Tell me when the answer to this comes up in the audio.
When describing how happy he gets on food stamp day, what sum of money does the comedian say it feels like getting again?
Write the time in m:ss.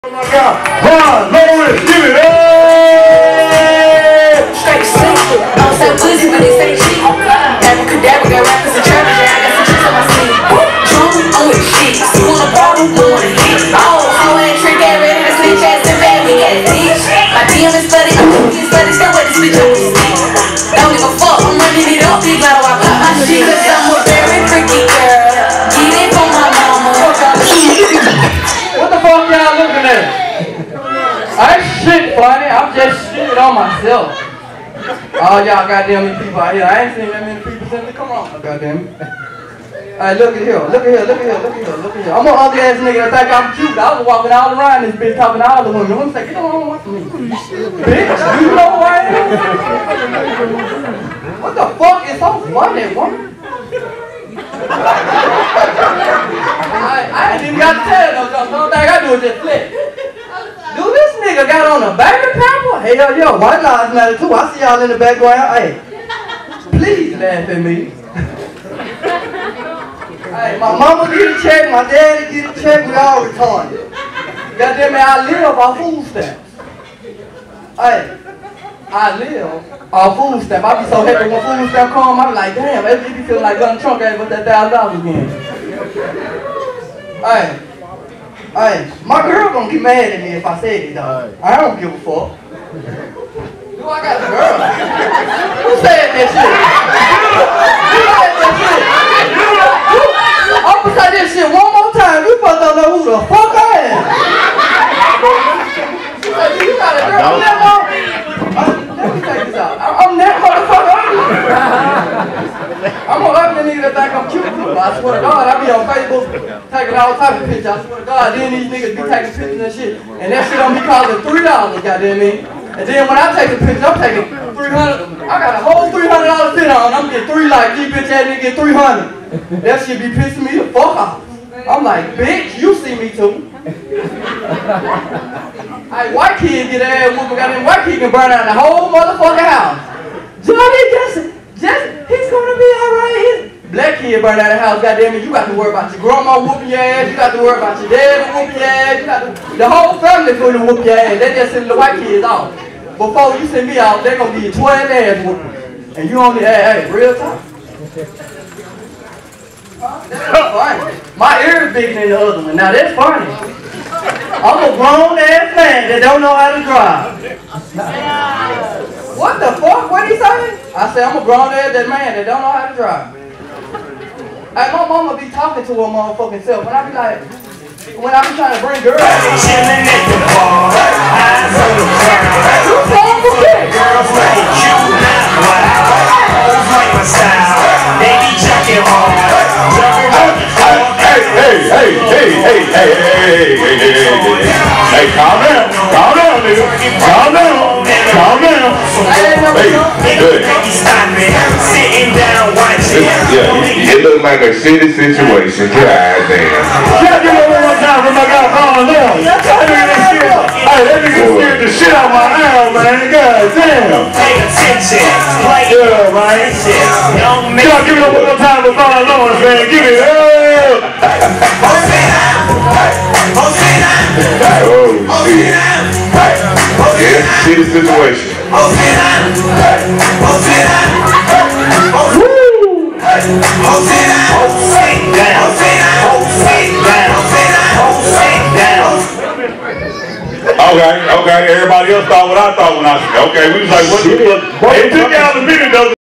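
1:24.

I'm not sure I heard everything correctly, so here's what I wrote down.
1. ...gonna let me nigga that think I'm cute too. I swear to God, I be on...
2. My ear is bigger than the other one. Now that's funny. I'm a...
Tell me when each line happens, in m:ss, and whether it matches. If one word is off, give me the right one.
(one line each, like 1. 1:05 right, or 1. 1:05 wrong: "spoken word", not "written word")
1. 1:53 right
2. 2:41 right.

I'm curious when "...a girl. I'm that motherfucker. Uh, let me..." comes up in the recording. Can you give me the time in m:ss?
1:46.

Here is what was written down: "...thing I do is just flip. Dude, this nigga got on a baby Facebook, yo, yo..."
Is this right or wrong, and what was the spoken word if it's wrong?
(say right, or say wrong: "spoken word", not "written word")
wrong: "Hey", not "Facebook".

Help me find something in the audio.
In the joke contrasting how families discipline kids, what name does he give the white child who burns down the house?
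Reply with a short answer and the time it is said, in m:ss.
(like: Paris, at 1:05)
Johnny, at 2:20.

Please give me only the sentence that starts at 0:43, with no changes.
I was walking all around this bitch talking to all the women.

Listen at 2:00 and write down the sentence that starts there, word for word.
And that shit don't be costing $3, goddamn it.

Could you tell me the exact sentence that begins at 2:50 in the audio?
I said I'm a grown ass that man that don't know how to drive.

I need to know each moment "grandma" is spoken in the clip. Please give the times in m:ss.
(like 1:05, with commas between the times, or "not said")
2:25.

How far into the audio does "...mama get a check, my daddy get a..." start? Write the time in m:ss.
1:10.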